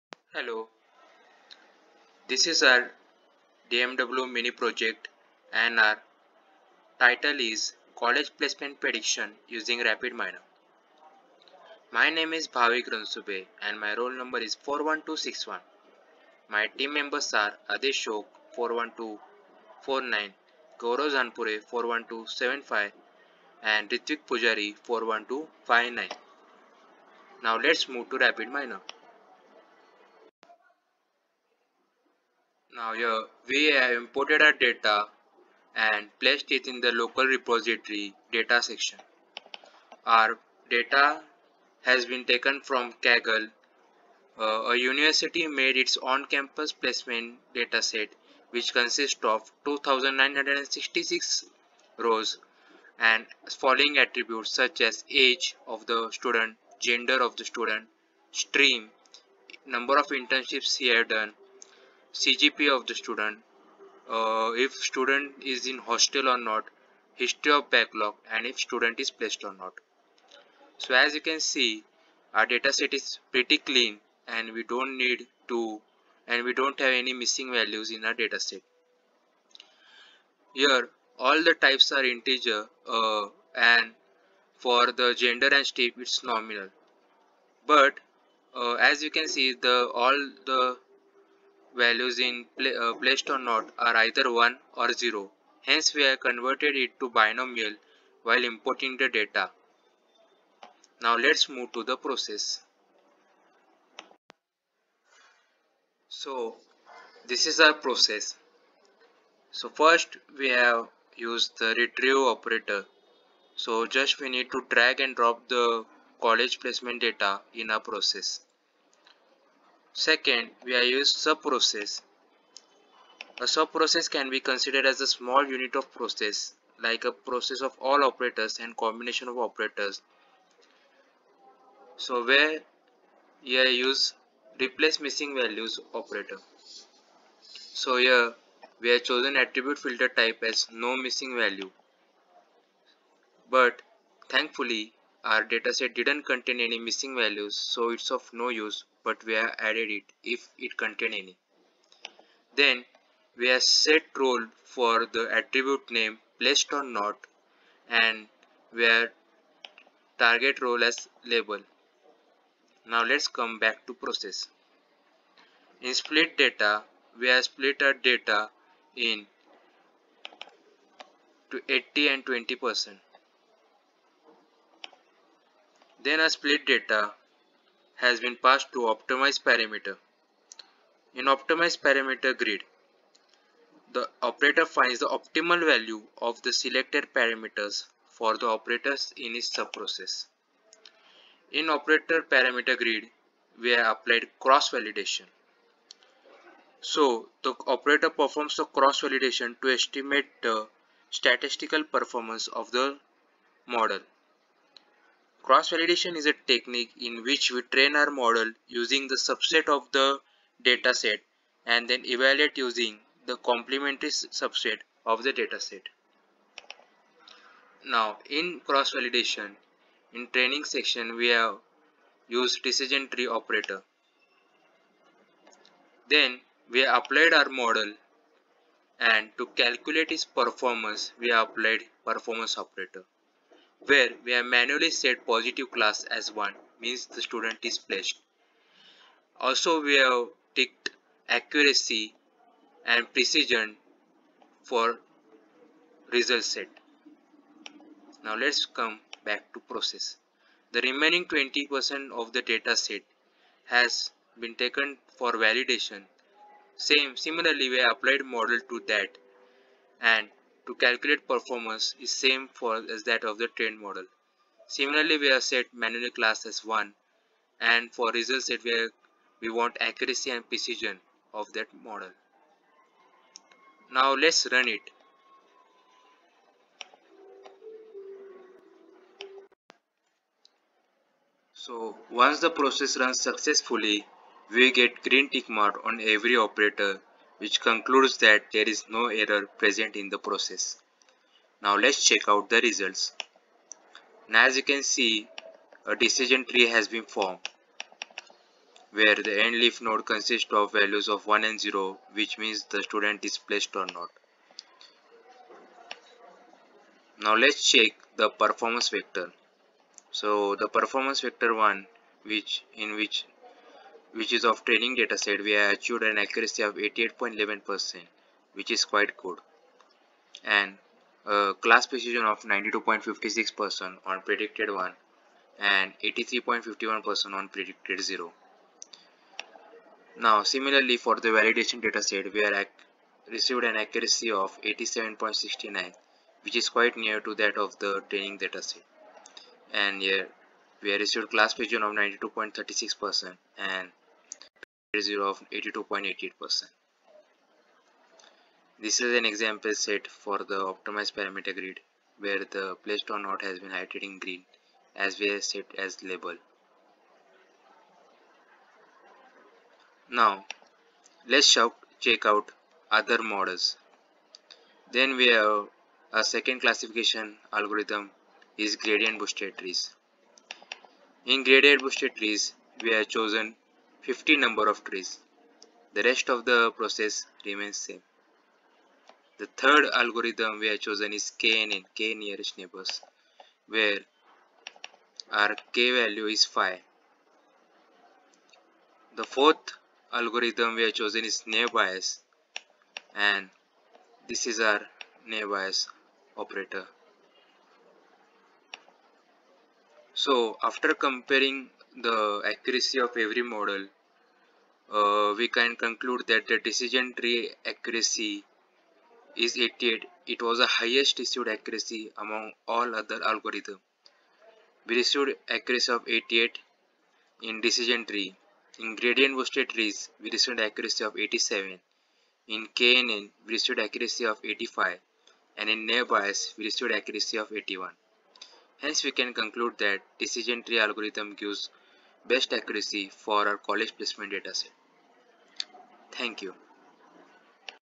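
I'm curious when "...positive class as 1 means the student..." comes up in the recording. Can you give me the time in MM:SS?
03:55.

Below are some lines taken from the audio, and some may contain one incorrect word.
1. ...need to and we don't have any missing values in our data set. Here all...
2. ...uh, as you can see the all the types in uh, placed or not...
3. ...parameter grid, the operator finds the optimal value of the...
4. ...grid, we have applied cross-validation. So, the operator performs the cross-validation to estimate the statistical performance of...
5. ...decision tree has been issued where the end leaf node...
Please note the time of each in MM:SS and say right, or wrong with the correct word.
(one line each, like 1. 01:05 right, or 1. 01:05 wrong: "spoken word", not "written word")
1. 01:14 right
2. 01:28 wrong: "values", not "types"
3. 03:01 right
4. 03:12 right
5. 04:55 wrong: "formed", not "issued".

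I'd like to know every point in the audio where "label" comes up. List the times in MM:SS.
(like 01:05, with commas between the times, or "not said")
02:41, 05:56.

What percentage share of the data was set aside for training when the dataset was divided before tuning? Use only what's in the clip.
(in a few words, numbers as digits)
80.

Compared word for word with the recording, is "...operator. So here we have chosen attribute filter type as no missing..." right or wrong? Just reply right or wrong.
right.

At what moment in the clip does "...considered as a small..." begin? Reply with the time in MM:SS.
02:04.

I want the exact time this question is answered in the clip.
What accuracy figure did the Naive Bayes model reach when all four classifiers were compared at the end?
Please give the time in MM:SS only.
07:07.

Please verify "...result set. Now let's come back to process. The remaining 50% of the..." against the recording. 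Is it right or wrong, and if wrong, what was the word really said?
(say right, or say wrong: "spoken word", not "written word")
wrong: "20", not "50".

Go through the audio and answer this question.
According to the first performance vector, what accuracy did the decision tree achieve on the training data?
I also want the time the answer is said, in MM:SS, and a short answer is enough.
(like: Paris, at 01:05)
88.11%, at 05:16.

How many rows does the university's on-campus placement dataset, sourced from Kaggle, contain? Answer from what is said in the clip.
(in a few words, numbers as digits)
2966.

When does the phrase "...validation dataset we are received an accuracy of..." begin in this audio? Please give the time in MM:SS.
05:31.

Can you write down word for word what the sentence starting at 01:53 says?
So just we need to drag and drop the college placement data in our process.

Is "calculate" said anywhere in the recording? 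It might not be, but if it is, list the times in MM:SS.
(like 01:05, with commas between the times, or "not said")
03:49, 04:20.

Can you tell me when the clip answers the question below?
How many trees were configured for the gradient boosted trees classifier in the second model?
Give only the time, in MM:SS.
06:14.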